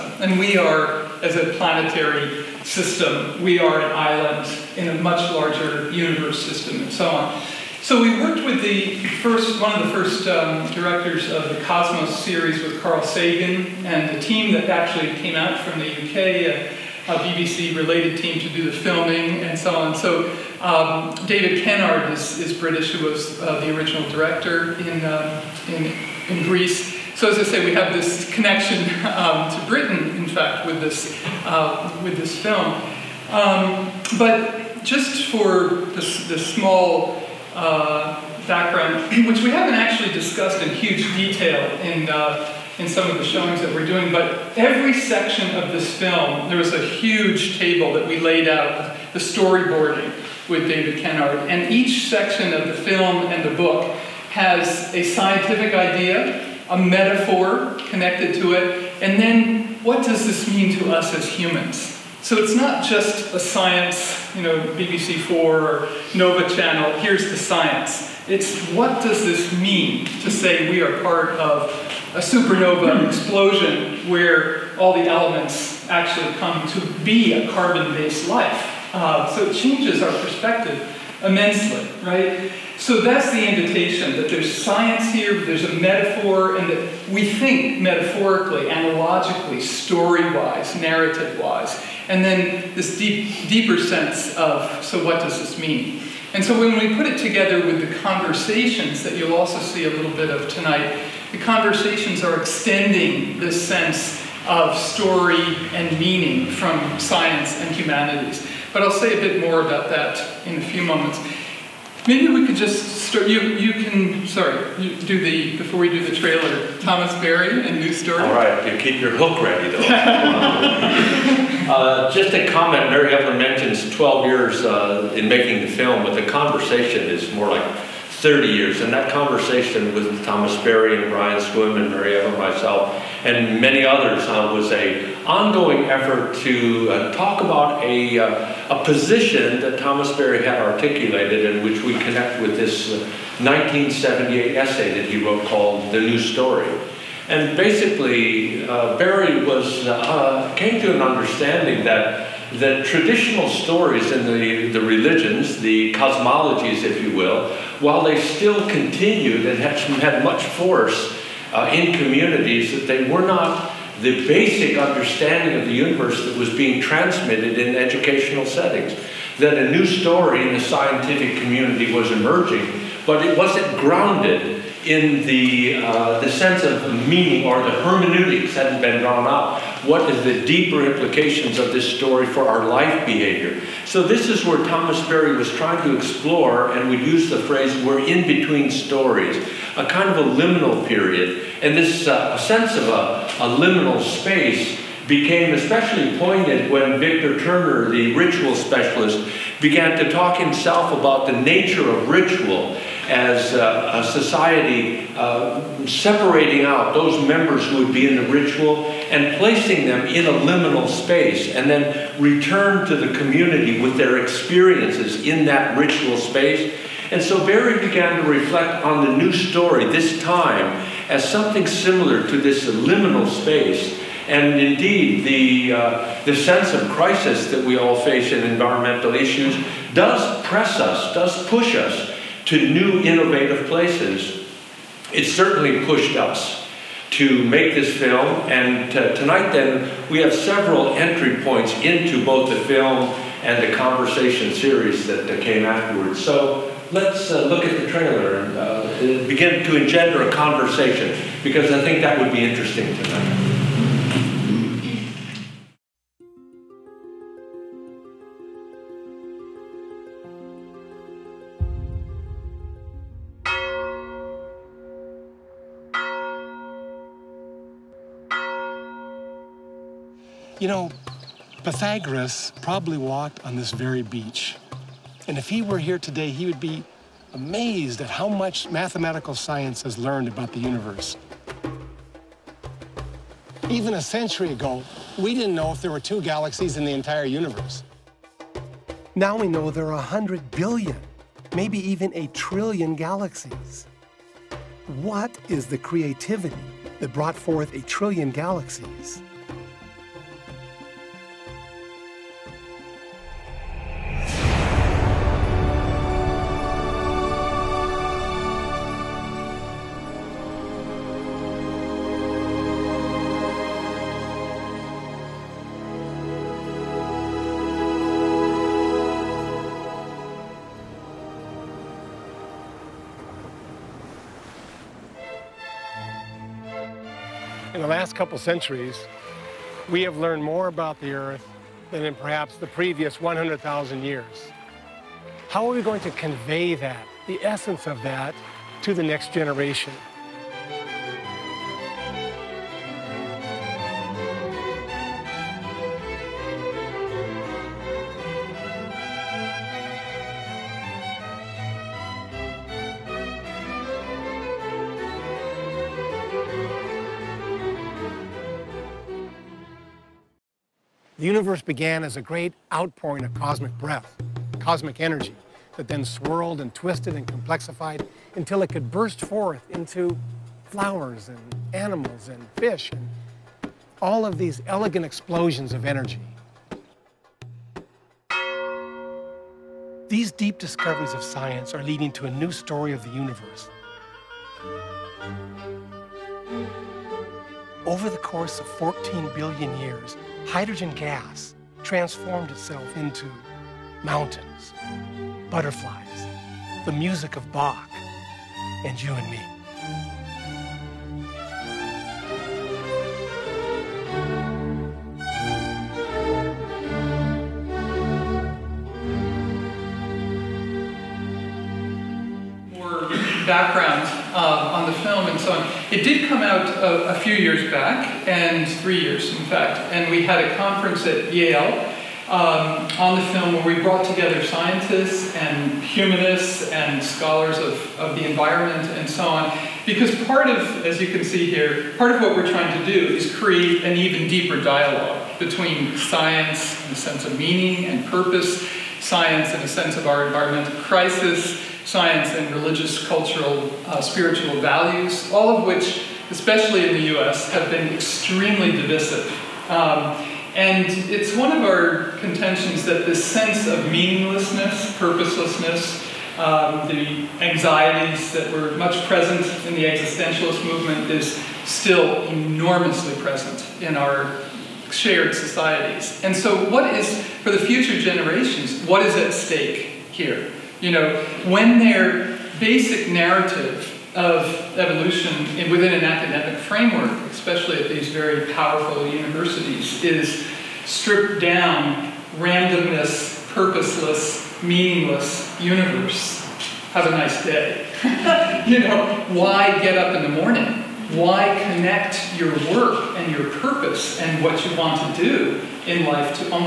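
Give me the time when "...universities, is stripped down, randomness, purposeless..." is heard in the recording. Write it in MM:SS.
07:59.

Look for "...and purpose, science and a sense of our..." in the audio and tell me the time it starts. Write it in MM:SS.
07:17.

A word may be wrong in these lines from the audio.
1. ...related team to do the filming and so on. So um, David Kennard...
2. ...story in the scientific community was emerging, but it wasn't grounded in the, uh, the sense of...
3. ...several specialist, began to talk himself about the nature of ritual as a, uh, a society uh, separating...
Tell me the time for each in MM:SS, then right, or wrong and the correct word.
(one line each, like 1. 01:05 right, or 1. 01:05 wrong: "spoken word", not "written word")
1. 00:17 right
2. 02:49 right
3. 03:18 wrong: "ritual", not "several".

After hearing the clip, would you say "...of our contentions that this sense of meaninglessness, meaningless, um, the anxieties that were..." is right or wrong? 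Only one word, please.
wrong.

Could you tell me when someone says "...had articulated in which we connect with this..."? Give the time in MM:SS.
02:20.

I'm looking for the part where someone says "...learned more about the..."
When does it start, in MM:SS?
05:30.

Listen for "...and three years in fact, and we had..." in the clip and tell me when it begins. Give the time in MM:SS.
06:58.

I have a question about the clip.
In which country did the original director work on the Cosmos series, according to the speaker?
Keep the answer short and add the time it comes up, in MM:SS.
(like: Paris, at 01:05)
Greece, at 00:26.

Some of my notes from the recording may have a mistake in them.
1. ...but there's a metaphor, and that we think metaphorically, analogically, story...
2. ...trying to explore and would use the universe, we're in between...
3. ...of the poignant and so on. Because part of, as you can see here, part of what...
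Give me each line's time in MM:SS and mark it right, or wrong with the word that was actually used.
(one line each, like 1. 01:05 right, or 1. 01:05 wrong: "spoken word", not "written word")
1. 01:25 right
2. 03:05 wrong: "phrase", not "universe"
3. 07:07 wrong: "environment", not "poignant".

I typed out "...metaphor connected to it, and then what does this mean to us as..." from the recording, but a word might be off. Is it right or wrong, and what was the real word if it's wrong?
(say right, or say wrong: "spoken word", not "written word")
right.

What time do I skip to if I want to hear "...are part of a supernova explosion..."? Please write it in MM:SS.
01:10.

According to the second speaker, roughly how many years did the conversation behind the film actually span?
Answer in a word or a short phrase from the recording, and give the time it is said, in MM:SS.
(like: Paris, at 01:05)
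30 years, at 02:08.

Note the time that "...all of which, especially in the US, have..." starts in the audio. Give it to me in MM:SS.
07:25.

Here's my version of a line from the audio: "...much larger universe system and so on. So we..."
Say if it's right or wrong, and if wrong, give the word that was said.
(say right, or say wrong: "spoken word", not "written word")
right.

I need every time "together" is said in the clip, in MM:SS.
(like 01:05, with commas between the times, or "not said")
01:37, 07:04.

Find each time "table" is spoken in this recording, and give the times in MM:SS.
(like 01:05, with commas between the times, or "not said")
00:47.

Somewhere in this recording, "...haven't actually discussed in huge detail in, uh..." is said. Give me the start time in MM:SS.
00:39.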